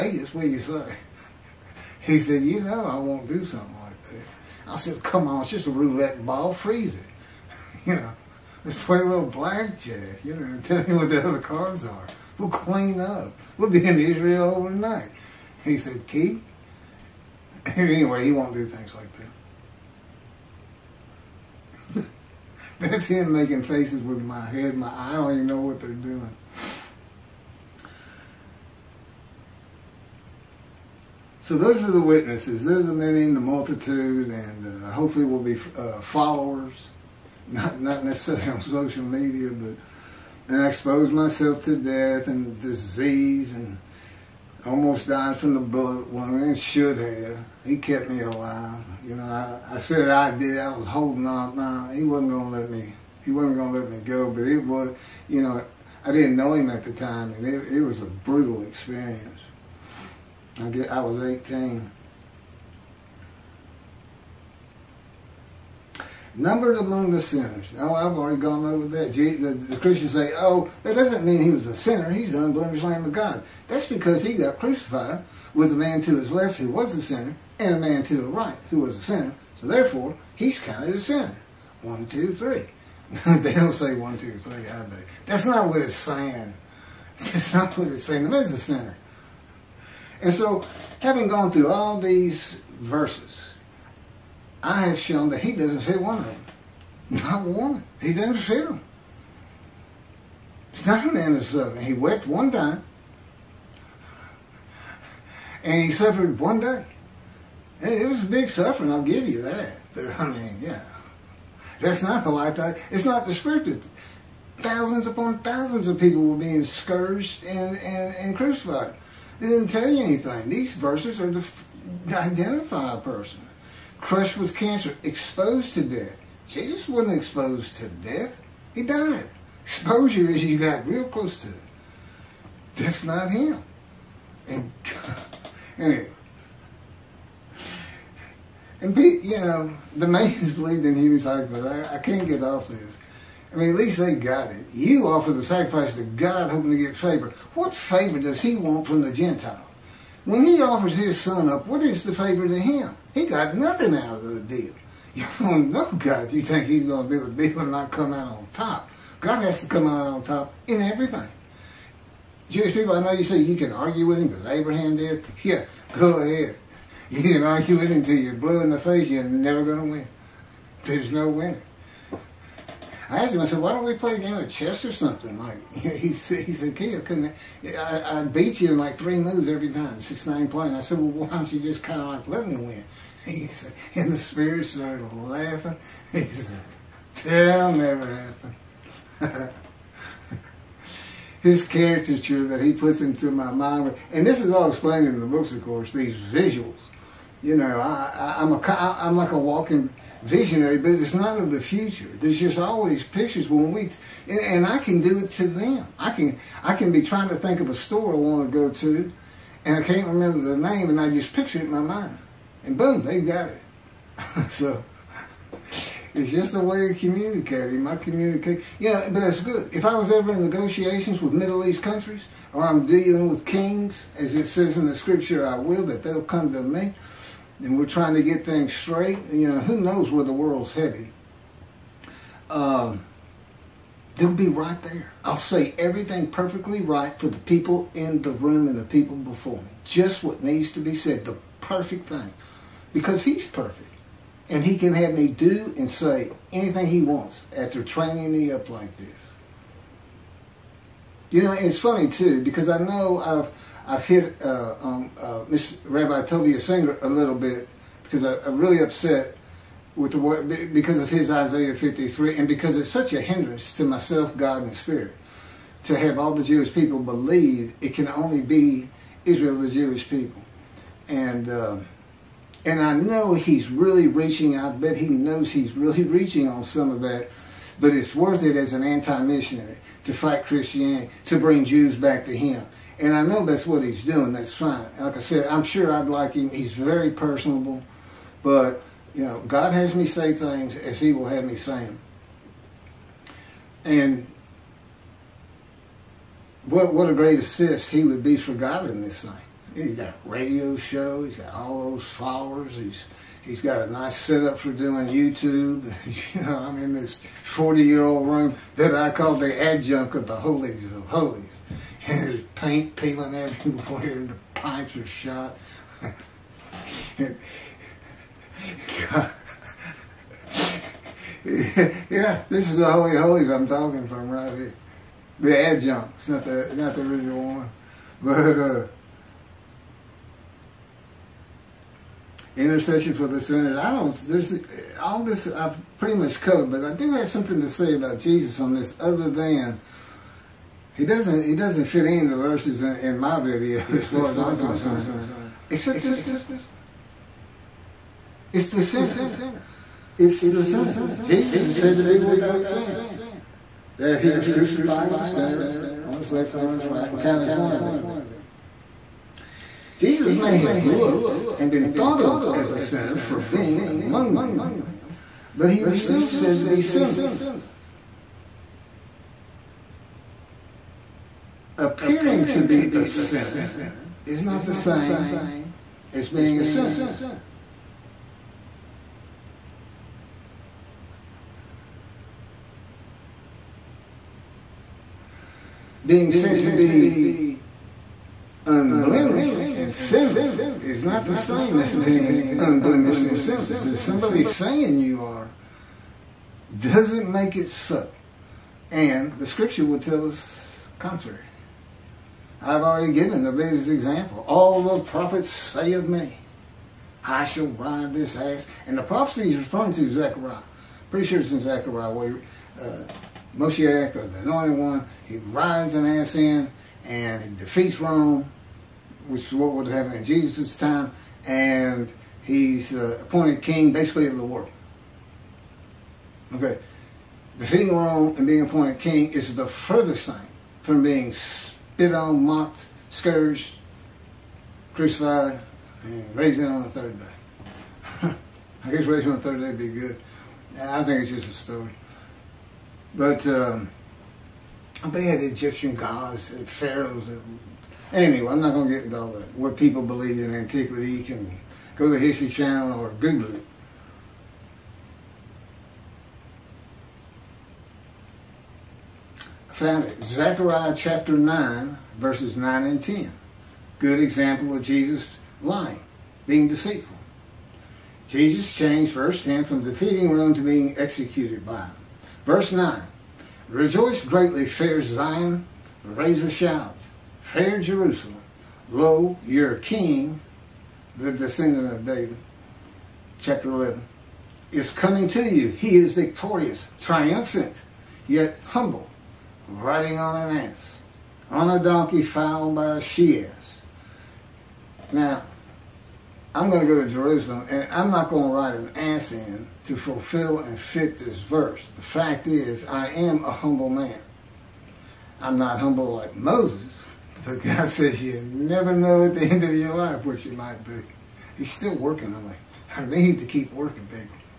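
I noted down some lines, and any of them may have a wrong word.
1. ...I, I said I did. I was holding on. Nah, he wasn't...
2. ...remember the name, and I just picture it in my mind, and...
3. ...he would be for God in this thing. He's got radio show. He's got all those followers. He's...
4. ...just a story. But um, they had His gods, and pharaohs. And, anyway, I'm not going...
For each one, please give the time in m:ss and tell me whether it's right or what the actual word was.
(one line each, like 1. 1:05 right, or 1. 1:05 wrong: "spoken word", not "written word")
1. 0:49 right
2. 3:30 right
3. 4:57 right
4. 7:21 wrong: "Egyptian", not "His".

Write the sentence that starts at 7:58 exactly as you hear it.
Lo, your king, the descendant of David.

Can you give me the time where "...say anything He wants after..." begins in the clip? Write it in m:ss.
4:05.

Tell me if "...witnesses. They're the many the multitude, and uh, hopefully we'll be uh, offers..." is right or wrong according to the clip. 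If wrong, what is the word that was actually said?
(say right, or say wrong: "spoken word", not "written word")
wrong: "followers", not "offers".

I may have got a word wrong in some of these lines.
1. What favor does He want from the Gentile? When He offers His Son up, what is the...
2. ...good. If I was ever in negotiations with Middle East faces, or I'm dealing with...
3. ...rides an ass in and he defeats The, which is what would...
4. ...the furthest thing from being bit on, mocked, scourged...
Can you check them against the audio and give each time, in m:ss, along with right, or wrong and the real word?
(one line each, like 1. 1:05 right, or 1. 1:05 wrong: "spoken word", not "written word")
1. 2:27 right
2. 3:39 wrong: "countries", not "faces"
3. 6:55 wrong: "Rome", not "The"
4. 7:09 right.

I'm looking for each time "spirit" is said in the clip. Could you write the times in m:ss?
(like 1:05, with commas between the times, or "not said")
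3:04, 4:24.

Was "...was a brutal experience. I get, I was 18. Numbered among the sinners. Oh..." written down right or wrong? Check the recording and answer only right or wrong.
right.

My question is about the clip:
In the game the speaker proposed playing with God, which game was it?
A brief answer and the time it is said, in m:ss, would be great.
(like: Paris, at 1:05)
chess, at 2:54.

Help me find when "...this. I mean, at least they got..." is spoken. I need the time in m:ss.
2:22.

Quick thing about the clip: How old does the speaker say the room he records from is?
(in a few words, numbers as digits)
40 years.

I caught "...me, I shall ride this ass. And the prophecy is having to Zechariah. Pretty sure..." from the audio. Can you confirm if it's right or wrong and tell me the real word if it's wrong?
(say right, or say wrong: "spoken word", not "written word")
wrong: "referring", not "having".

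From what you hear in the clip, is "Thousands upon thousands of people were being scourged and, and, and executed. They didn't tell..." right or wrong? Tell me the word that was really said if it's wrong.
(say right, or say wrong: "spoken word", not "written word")
wrong: "crucified", not "executed".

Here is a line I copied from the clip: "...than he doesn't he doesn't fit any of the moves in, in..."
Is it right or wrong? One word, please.
wrong.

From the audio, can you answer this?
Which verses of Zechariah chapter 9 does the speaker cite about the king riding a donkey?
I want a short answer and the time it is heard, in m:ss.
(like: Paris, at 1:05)
9 and 10, at 7:42.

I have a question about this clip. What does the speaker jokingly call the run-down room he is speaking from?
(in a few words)
the adjunct of the holies of holies.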